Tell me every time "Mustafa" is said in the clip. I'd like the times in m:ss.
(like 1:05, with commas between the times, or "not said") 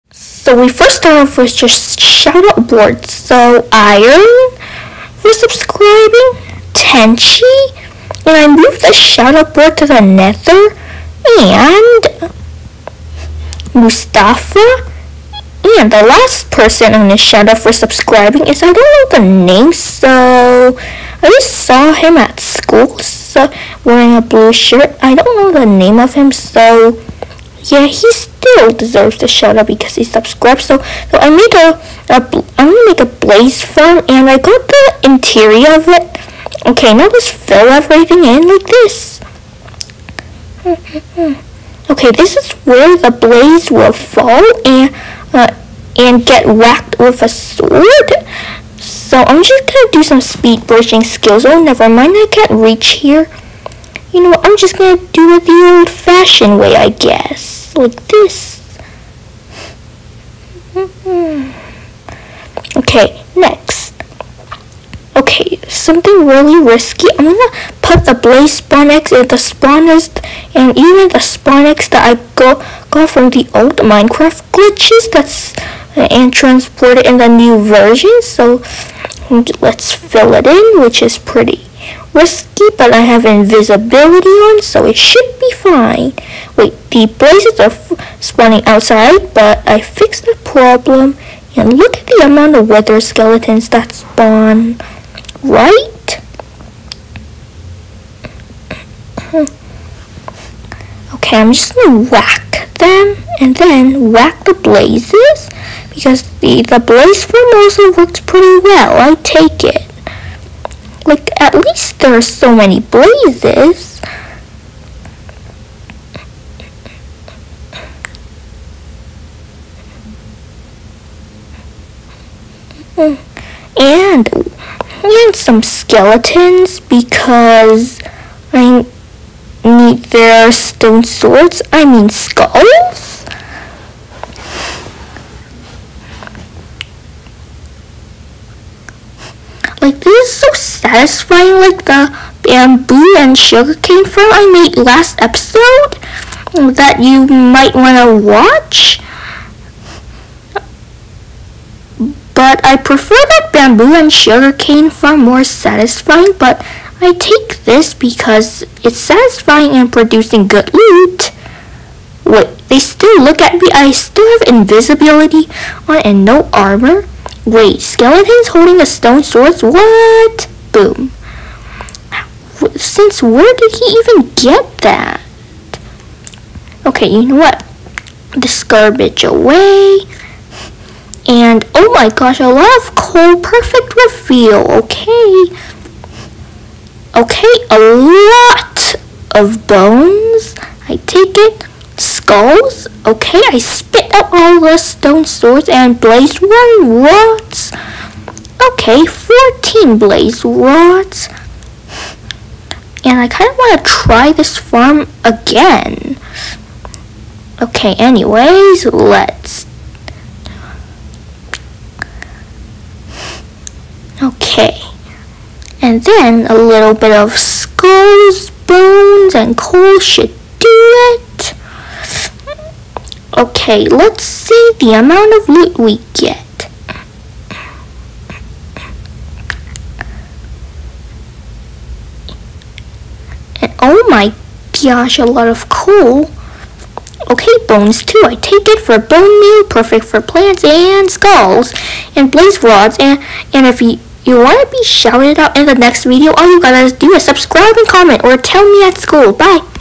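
0:13.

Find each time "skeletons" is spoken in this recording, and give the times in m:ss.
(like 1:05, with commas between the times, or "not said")
1:33, 2:05, 2:47.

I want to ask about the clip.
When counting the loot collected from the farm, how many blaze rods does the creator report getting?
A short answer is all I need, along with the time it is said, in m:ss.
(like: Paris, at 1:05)
14, at 3:19.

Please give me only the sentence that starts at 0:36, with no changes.
Okay, now let's fill everything in like this.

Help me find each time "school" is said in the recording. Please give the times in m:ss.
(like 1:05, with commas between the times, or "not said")
0:22, 4:08.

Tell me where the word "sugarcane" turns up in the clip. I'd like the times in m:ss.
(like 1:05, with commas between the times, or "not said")
2:23, 2:34.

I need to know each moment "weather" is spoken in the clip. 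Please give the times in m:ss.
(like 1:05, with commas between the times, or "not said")
1:32.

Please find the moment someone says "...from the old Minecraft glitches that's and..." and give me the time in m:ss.
1:13.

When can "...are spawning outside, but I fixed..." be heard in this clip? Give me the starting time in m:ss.
1:27.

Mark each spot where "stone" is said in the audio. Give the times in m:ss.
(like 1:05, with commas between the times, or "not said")
2:10, 2:48, 3:14.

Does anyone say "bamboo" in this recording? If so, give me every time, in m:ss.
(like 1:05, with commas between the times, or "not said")
2:22, 2:33.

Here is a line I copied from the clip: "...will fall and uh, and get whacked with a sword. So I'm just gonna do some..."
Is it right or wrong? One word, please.
right.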